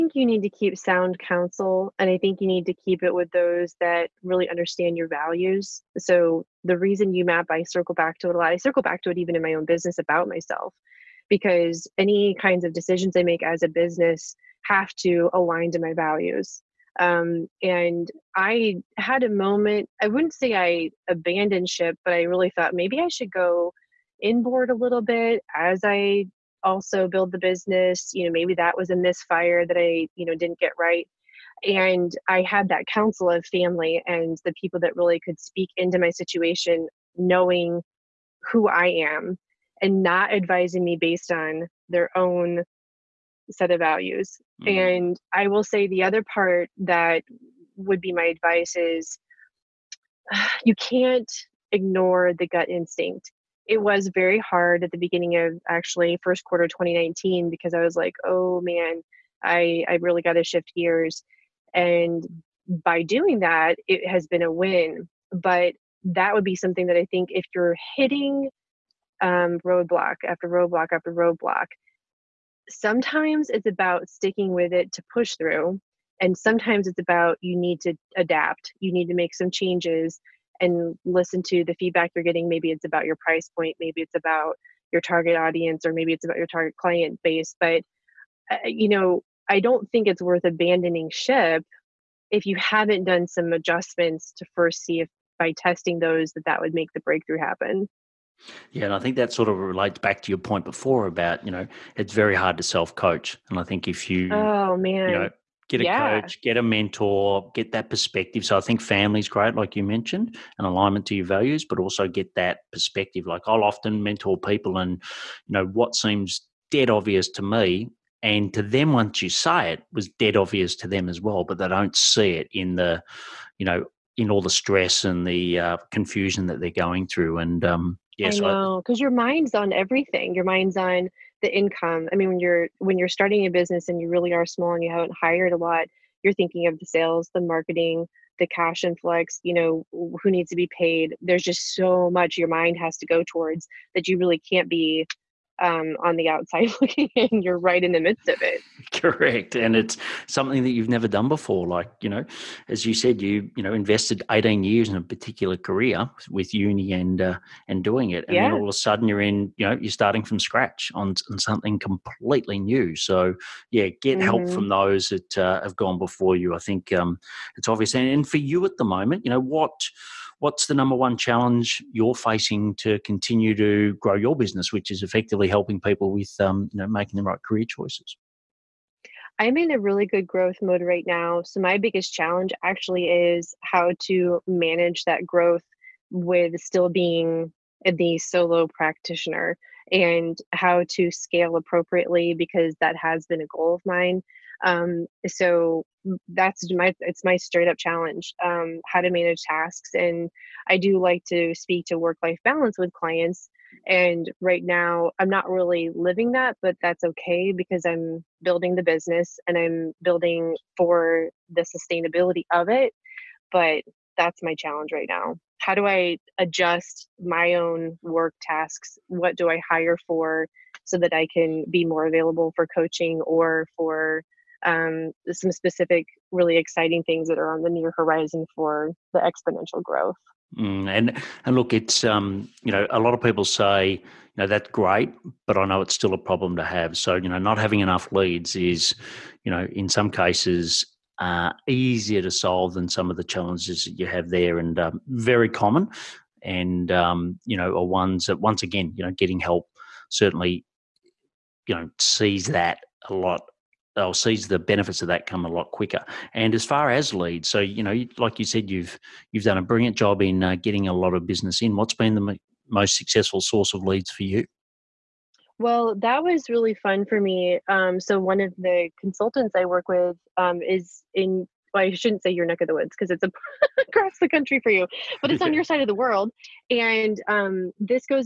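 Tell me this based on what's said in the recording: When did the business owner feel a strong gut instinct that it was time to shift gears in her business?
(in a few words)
First quarter 2019.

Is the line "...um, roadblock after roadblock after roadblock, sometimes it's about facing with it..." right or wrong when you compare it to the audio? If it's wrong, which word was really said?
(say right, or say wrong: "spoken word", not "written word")
wrong: "sticking", not "facing".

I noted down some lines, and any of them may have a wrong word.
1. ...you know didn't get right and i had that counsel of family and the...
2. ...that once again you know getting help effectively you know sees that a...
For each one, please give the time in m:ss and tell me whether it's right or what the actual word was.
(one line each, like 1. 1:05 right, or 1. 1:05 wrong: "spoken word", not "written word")
1. 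0:30 right
2. 4:08 wrong: "certainly", not "effectively".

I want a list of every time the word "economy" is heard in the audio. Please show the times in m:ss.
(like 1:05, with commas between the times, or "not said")
not said.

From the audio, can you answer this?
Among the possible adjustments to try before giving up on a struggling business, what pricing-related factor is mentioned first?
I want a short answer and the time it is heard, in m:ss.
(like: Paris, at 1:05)
Price point, at 1:23.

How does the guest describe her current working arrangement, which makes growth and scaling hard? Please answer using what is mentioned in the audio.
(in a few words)
Solo practitioner.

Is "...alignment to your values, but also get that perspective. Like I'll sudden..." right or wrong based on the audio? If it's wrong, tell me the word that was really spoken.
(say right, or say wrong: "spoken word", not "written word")
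wrong: "often", not "sudden".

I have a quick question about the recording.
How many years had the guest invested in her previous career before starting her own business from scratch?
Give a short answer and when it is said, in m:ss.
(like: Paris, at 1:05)
18, at 2:34.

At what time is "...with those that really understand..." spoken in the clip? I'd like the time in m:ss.
0:03.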